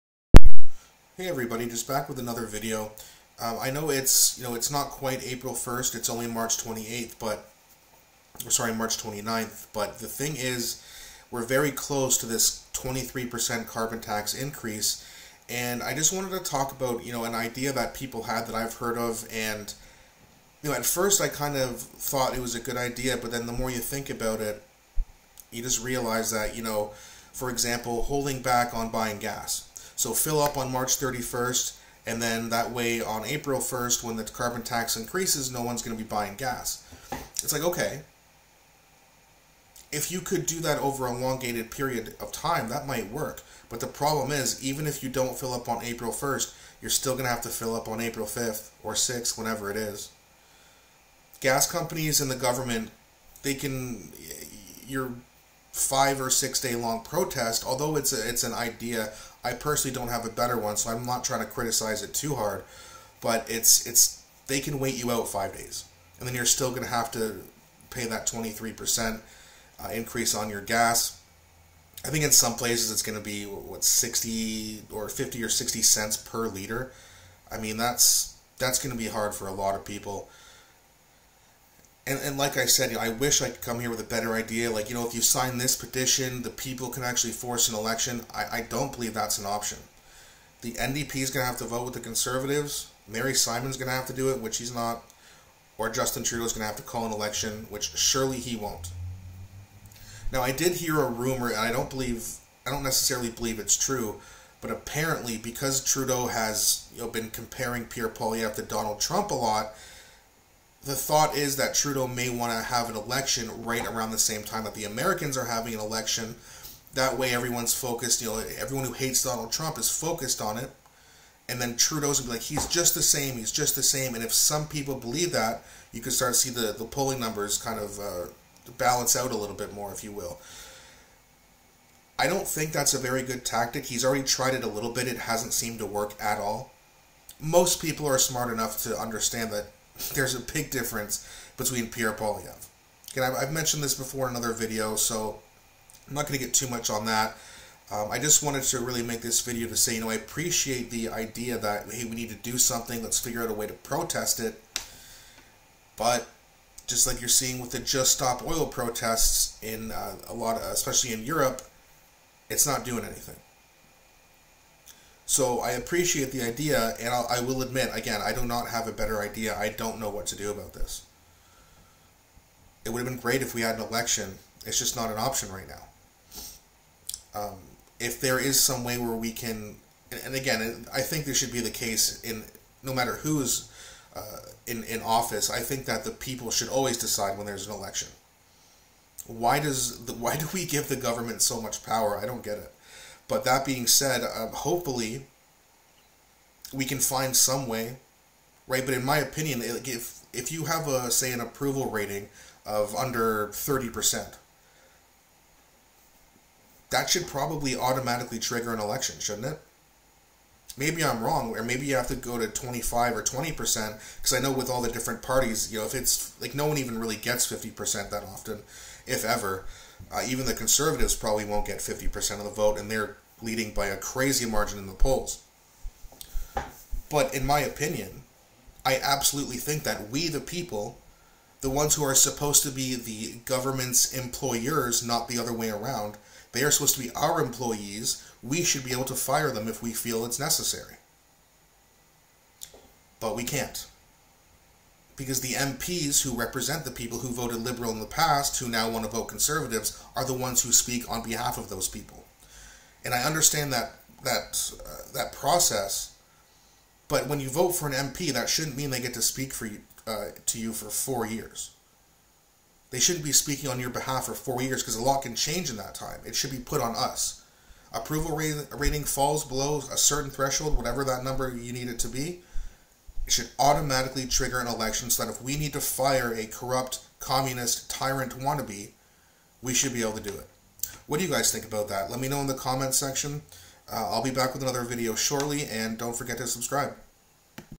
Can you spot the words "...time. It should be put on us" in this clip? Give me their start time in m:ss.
4:25.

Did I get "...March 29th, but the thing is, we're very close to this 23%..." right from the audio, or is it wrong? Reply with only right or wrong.
right.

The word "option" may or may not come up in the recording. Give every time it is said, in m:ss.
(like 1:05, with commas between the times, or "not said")
1:29, 2:55.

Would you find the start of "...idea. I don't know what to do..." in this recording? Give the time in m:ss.
2:49.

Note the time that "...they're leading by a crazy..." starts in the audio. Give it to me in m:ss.
3:42.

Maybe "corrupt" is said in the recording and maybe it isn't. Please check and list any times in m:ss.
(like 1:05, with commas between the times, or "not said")
4:36.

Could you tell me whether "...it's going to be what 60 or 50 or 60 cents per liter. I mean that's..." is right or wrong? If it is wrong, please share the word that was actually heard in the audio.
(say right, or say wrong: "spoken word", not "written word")
right.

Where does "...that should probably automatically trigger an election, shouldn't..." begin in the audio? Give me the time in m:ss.
3:26.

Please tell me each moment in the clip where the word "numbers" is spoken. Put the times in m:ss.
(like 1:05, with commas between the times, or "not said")
2:07, 4:31.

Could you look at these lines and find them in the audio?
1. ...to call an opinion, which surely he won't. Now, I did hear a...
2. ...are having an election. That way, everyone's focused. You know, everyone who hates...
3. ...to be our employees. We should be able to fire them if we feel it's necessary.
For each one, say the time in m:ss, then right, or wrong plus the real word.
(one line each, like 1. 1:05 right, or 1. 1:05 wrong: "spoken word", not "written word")
1. 1:36 wrong: "election", not "opinion"
2. 1:55 right
3. 3:56 right.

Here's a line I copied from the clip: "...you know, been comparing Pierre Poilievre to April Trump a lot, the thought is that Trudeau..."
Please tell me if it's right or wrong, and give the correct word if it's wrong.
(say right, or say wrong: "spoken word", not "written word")
wrong: "Donald", not "April".